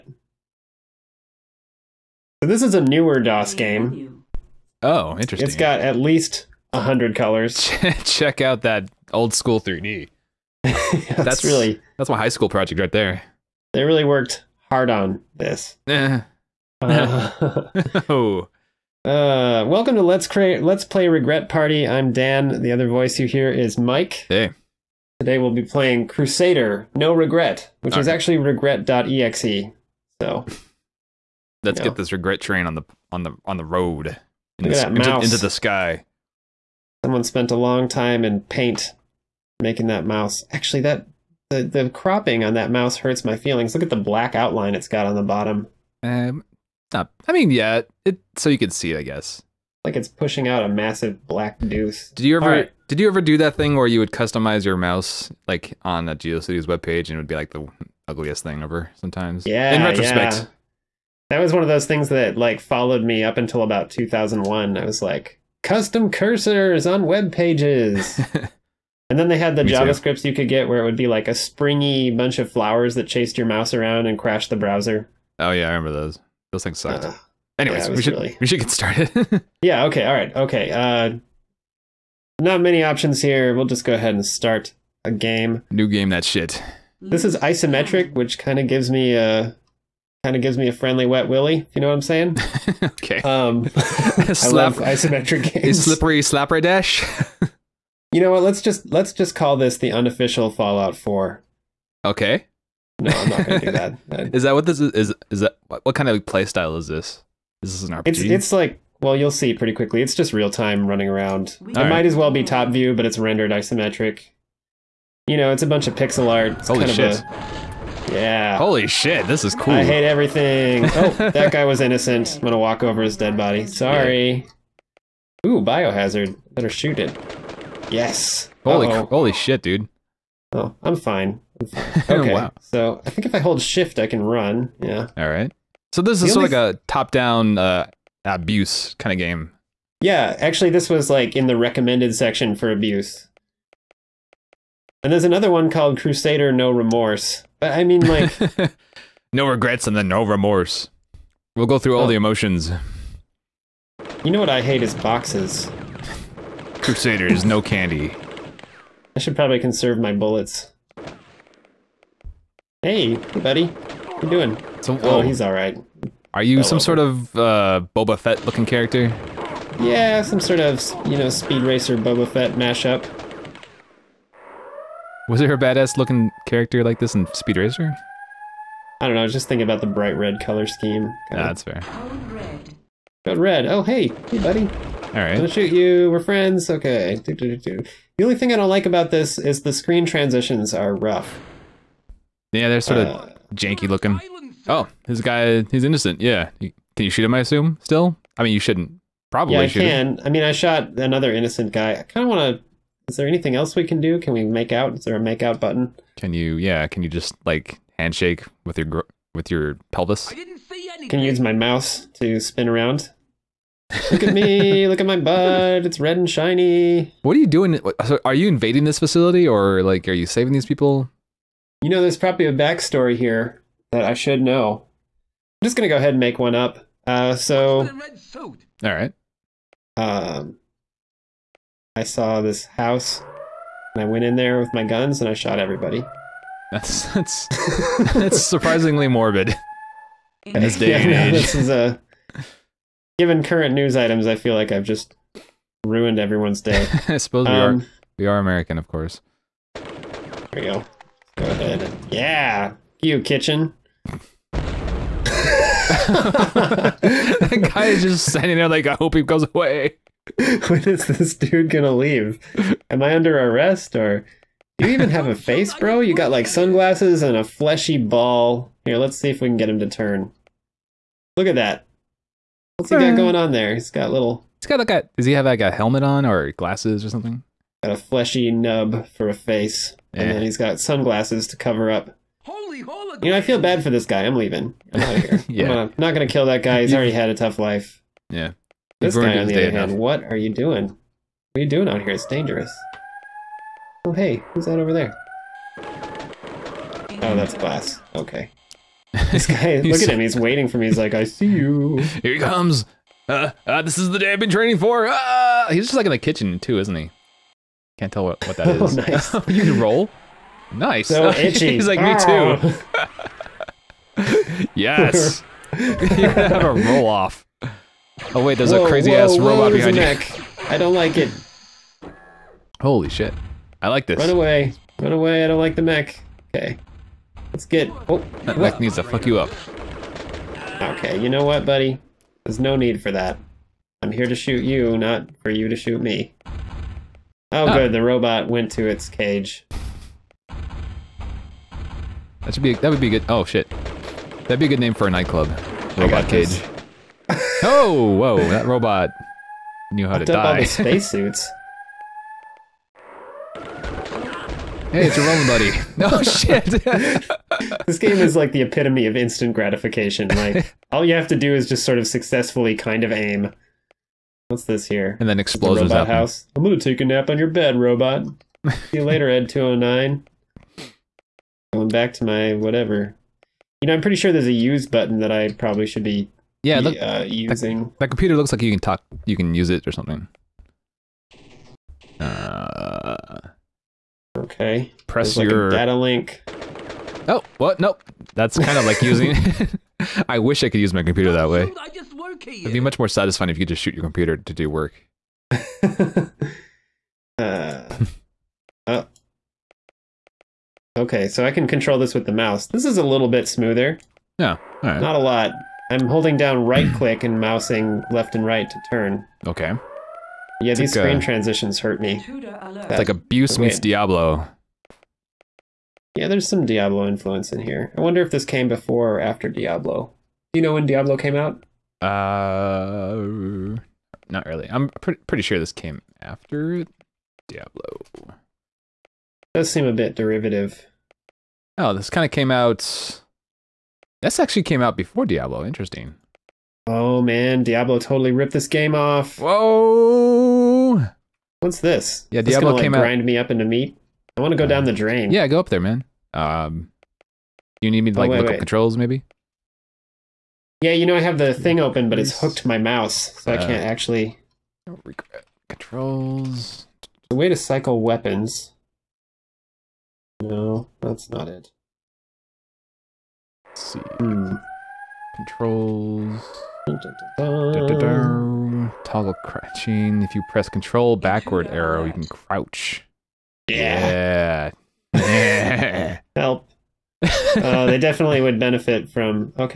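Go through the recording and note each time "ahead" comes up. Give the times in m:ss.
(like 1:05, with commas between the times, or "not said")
1:23, 3:45, 4:11.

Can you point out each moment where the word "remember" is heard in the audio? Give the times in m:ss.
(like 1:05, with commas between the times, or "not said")
1:15.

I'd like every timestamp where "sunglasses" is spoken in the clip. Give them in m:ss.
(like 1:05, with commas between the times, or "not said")
4:26, 4:40.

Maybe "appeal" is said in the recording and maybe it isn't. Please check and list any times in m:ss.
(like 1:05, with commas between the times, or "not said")
not said.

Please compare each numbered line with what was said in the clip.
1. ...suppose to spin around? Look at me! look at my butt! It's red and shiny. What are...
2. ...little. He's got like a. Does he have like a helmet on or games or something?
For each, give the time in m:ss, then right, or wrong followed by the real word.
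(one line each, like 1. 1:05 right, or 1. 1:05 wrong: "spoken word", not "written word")
1. 3:31 wrong: "mouse", not "suppose"
2. 4:34 wrong: "glasses", not "games".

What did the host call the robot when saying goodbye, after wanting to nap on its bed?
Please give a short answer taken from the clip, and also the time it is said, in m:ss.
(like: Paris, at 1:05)
Ed 209, at 6:09.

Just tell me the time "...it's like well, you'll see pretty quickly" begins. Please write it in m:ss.
1:48.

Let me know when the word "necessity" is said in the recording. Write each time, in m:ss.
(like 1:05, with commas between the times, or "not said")
not said.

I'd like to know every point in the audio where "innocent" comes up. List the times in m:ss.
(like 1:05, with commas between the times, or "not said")
2:01, 3:15, 3:21.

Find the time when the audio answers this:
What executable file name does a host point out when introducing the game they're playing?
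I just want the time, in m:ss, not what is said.
0:28.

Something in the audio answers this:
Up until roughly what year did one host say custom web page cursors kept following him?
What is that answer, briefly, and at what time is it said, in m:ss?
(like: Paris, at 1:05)
2001, at 1:03.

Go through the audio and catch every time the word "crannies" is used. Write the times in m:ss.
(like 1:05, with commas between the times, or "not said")
not said.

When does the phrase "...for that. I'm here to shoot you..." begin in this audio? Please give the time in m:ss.
5:33.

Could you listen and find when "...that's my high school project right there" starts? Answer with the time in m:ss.
0:11.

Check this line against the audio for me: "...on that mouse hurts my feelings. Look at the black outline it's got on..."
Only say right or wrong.
right.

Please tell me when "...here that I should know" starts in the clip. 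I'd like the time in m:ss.
3:43.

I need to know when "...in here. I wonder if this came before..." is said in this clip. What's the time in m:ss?
6:57.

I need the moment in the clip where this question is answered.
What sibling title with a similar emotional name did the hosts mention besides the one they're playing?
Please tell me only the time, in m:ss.
2:25.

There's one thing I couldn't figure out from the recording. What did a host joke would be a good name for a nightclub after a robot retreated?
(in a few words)
Robot cage.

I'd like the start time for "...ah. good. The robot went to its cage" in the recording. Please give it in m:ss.
5:37.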